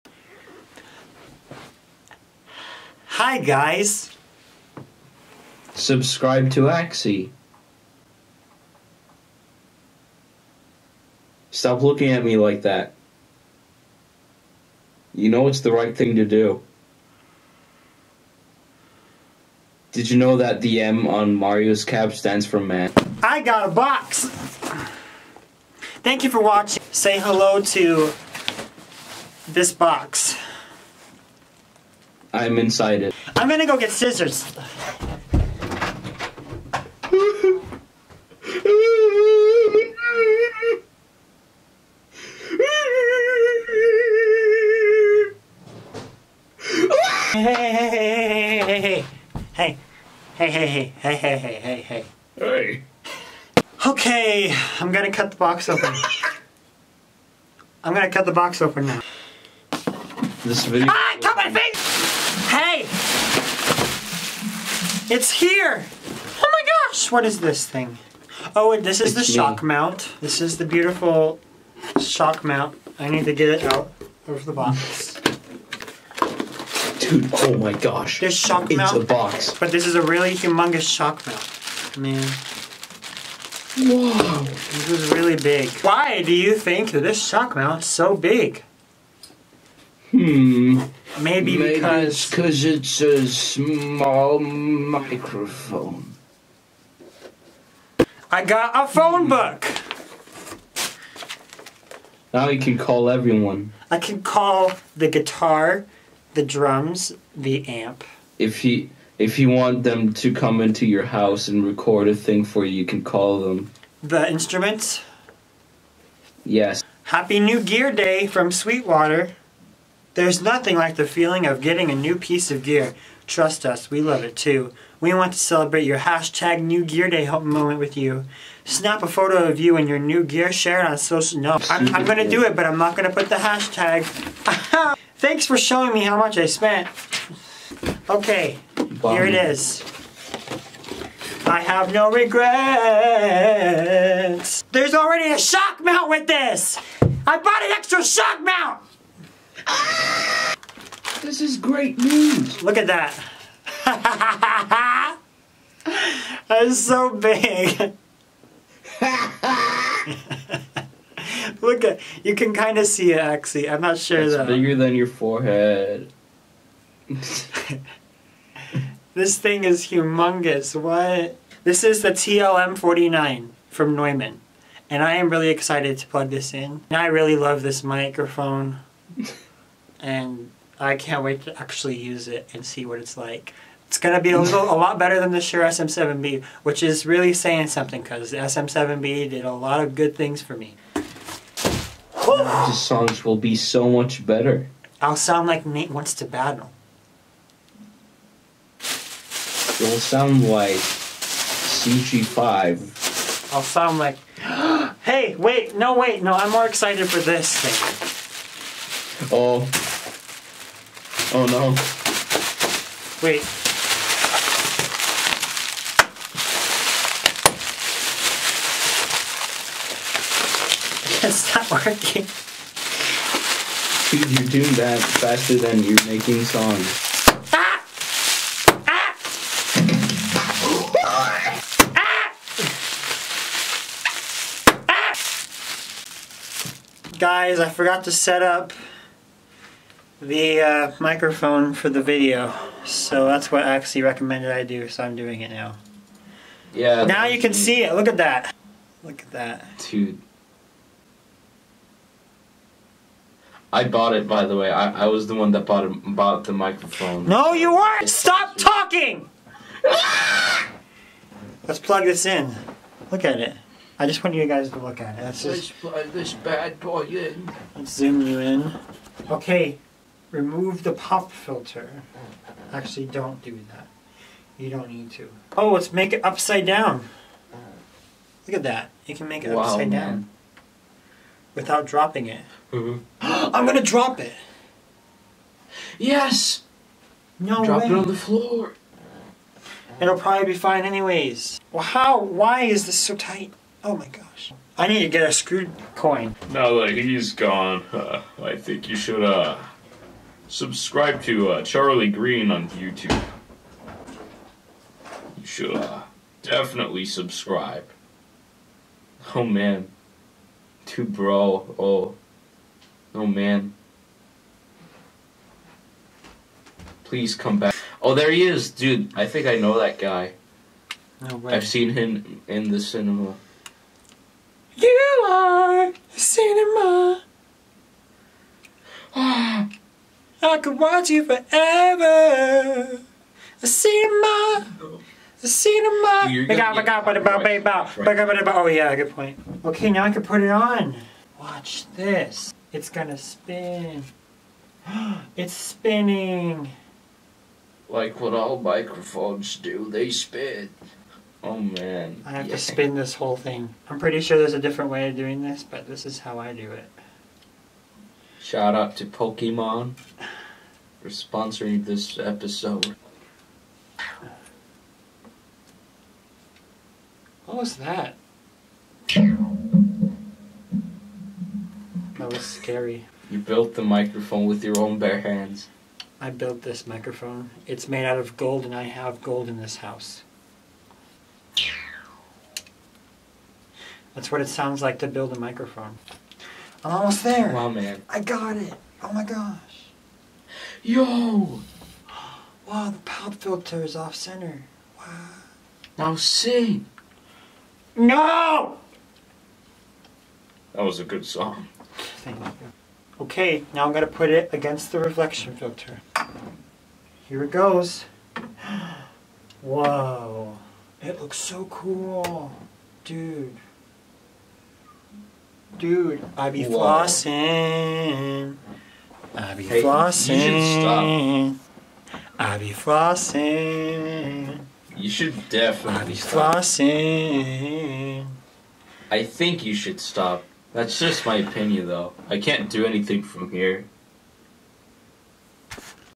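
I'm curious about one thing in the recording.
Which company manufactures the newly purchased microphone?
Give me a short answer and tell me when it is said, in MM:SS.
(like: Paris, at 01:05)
Neumann, at 02:53.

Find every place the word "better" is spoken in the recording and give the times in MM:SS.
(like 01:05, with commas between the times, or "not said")
03:04, 03:14.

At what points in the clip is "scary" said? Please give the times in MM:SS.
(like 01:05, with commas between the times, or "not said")
06:12.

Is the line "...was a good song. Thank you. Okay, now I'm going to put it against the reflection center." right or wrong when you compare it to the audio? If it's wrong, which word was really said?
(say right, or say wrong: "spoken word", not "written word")
wrong: "filter", not "center".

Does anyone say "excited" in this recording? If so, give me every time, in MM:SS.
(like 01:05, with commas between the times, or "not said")
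02:55, 03:26.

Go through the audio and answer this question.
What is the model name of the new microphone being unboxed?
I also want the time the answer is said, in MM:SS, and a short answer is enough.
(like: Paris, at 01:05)
TLM49, at 02:52.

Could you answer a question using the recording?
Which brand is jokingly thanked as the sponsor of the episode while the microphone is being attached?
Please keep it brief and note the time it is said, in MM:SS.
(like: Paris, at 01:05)
Pokemon, at 05:59.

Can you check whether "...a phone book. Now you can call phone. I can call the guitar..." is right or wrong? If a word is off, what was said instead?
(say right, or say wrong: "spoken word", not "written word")
wrong: "everyone", not "phone".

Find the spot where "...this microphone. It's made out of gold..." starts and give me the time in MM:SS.
06:16.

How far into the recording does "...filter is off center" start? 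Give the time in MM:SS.
06:33.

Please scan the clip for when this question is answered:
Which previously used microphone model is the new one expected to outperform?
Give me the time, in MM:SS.
03:05.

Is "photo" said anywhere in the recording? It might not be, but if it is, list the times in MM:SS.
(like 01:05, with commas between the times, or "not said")
02:09.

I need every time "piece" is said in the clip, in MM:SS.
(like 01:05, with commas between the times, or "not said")
02:02.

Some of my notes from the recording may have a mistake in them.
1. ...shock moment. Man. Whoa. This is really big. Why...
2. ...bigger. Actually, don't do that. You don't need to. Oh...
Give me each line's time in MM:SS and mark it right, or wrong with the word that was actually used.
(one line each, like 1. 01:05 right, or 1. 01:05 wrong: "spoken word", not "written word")
1. 01:20 wrong: "mount", not "moment"
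2. 04:31 wrong: "filter", not "bigger".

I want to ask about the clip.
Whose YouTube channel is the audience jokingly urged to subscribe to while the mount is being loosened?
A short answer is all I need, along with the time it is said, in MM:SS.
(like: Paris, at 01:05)
Charlie Green, at 05:01.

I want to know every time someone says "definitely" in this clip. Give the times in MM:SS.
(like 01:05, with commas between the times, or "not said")
05:06, 07:05.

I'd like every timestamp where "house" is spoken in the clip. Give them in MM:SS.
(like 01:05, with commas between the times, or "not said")
01:51, 06:19.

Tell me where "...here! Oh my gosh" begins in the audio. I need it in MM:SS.
01:05.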